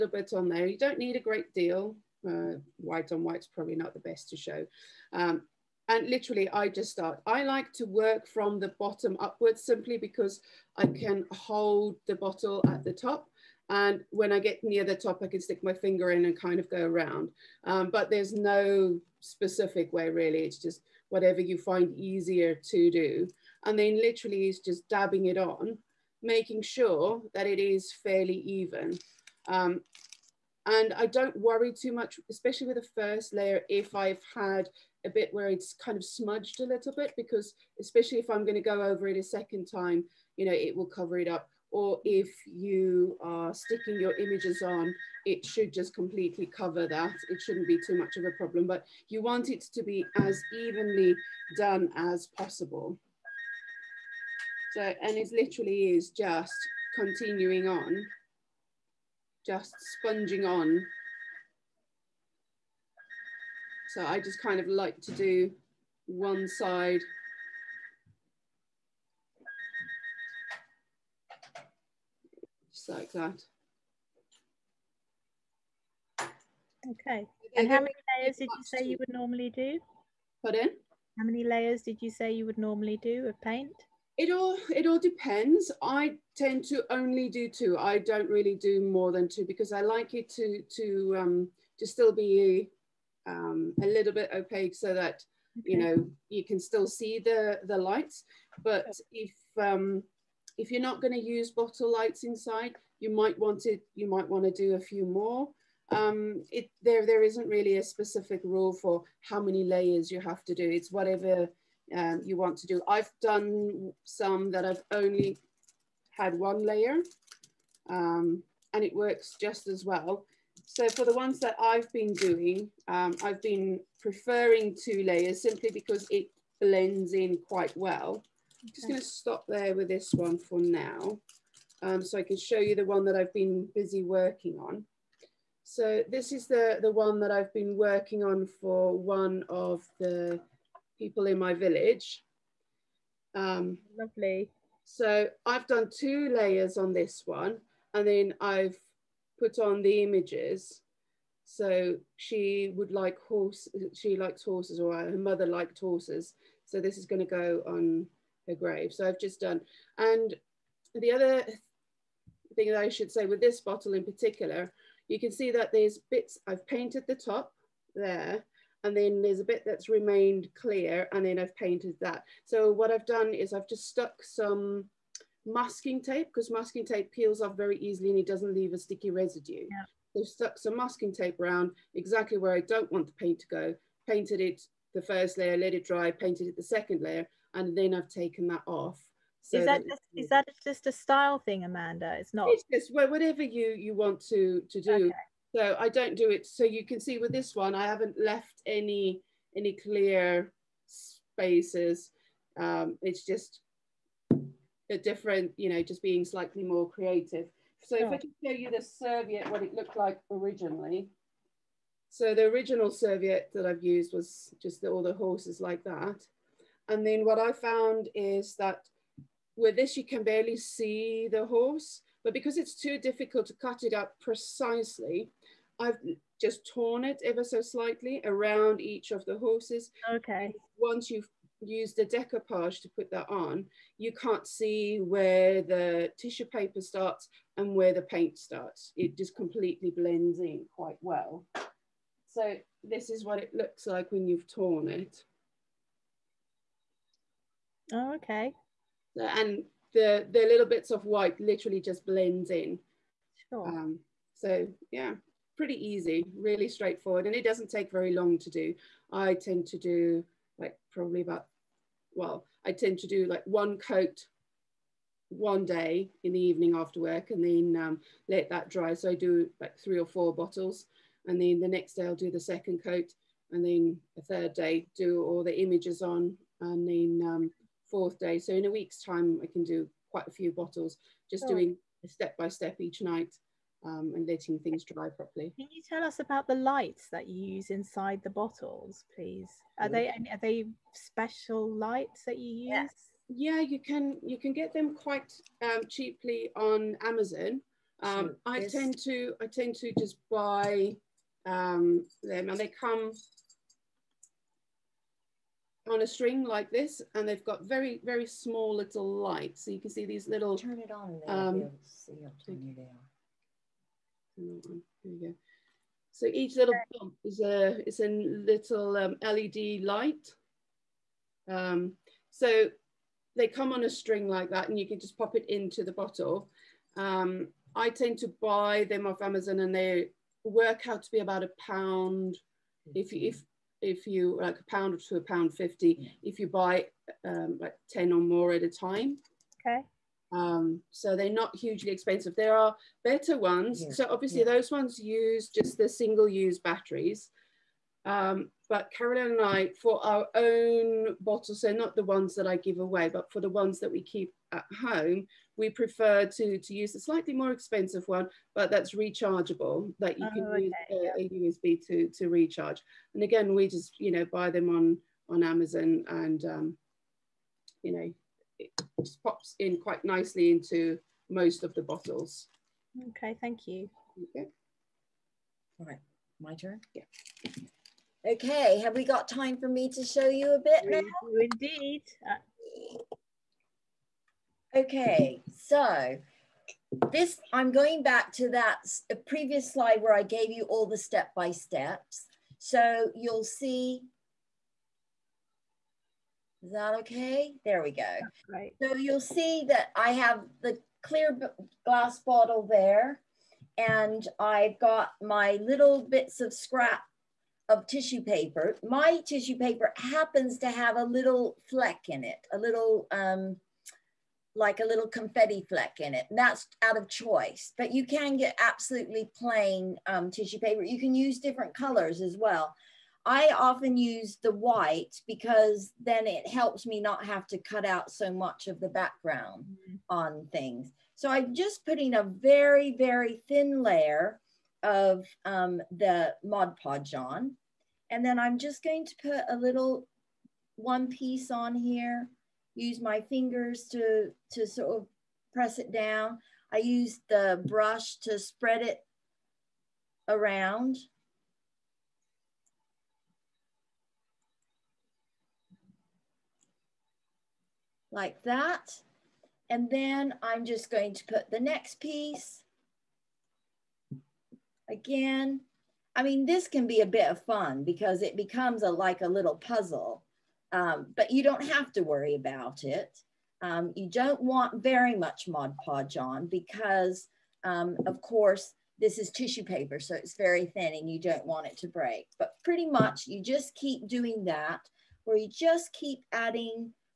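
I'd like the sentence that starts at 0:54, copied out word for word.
So, and it literally is just continuing on, just sponging on.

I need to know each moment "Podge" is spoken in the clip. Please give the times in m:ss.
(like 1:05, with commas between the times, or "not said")
7:16, 7:55.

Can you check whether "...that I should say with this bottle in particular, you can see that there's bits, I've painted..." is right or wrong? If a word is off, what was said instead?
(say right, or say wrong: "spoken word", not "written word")
right.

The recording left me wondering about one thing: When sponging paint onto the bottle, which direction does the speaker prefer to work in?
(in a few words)
bottom upwards.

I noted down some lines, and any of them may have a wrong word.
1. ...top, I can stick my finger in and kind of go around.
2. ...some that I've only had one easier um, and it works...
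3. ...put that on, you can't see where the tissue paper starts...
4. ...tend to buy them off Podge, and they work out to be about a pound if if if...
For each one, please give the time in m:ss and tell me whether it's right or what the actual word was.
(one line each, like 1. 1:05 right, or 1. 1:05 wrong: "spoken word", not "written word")
1. 0:14 right
2. 1:54 wrong: "layer", not "easier"
3. 3:52 right
4. 5:27 wrong: "Amazon", not "Podge".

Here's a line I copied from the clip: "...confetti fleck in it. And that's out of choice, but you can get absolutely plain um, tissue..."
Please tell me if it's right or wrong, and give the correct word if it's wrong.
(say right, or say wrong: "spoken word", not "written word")
right.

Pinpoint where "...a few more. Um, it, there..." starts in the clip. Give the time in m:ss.
1:44.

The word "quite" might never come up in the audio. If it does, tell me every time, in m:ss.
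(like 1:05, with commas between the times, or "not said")
2:07, 4:00, 4:40, 4:54, 6:09.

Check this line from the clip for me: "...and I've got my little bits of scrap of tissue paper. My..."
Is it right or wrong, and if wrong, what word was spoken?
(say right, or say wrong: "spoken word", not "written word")
right.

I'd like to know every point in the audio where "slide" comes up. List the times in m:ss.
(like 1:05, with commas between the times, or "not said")
6:29.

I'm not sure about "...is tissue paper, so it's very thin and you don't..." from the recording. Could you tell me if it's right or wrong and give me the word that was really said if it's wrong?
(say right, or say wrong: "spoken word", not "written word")
right.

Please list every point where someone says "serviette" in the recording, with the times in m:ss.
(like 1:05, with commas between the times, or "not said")
3:28, 3:32.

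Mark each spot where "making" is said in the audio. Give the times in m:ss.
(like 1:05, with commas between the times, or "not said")
0:26.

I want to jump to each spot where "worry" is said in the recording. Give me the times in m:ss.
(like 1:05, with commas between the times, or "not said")
0:31, 7:52.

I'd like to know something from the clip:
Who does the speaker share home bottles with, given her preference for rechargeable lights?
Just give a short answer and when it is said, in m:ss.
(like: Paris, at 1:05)
Carolyn, at 5:48.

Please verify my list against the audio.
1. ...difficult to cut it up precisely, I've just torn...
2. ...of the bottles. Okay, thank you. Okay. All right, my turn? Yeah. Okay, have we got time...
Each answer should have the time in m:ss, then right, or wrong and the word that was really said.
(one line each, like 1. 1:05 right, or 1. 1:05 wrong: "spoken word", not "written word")
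1. 3:42 right
2. 6:11 right.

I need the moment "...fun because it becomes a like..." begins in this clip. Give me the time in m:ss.
7:47.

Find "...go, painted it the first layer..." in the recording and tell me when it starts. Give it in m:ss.
3:03.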